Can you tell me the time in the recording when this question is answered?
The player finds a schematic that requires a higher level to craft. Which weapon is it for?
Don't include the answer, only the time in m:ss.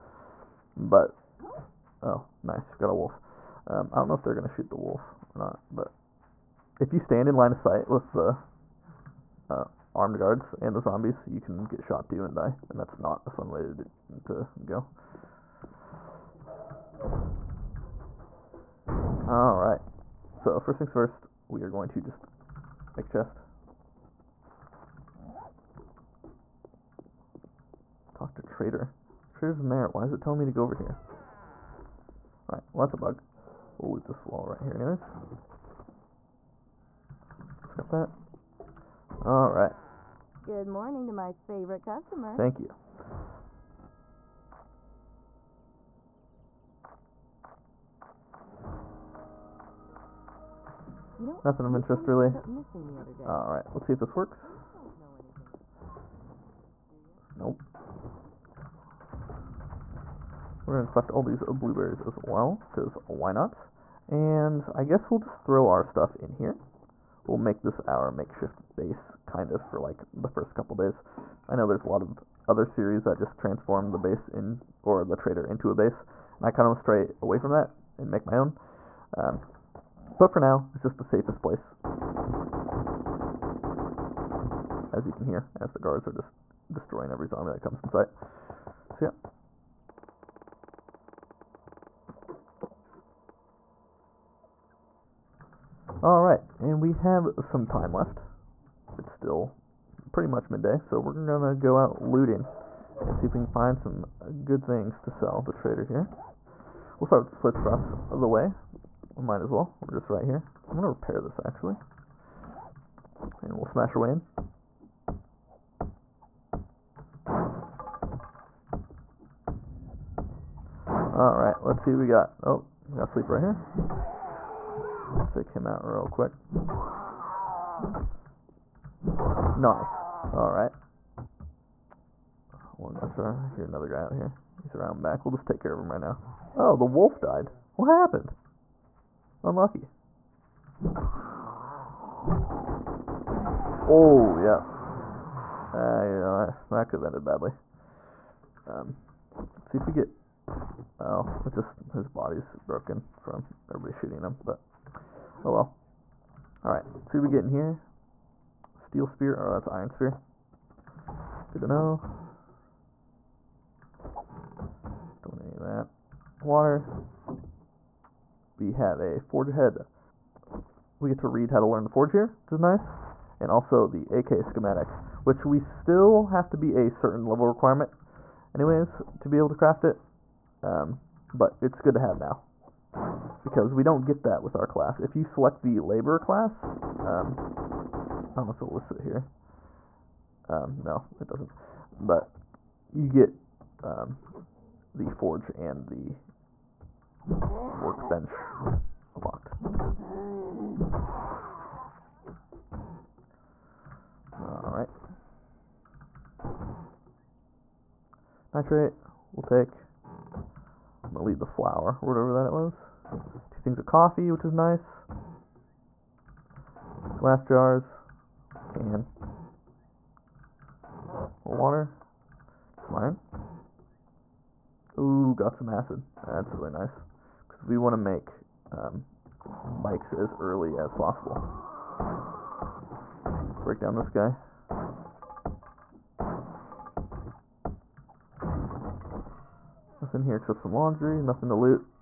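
2:54.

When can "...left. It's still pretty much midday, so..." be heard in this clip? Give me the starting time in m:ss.
1:37.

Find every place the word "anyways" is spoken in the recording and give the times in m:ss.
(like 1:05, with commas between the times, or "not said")
0:34, 2:58.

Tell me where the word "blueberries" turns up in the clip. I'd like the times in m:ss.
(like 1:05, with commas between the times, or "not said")
1:01.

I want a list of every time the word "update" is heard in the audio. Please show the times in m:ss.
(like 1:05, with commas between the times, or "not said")
not said.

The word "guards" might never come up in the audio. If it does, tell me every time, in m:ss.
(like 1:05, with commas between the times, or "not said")
0:10, 1:25.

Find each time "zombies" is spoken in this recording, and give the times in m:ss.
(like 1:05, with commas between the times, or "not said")
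0:10, 1:27.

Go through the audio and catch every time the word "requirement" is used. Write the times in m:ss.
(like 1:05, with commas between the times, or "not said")
2:57.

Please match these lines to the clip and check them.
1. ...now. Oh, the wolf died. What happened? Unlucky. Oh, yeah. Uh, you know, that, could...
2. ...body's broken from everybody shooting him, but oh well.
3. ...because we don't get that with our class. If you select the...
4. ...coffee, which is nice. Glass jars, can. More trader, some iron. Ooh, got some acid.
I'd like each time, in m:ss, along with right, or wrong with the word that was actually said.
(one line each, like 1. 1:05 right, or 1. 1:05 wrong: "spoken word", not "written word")
1. 2:15 right
2. 2:32 right
3. 3:03 right
4. 3:33 wrong: "water", not "trader".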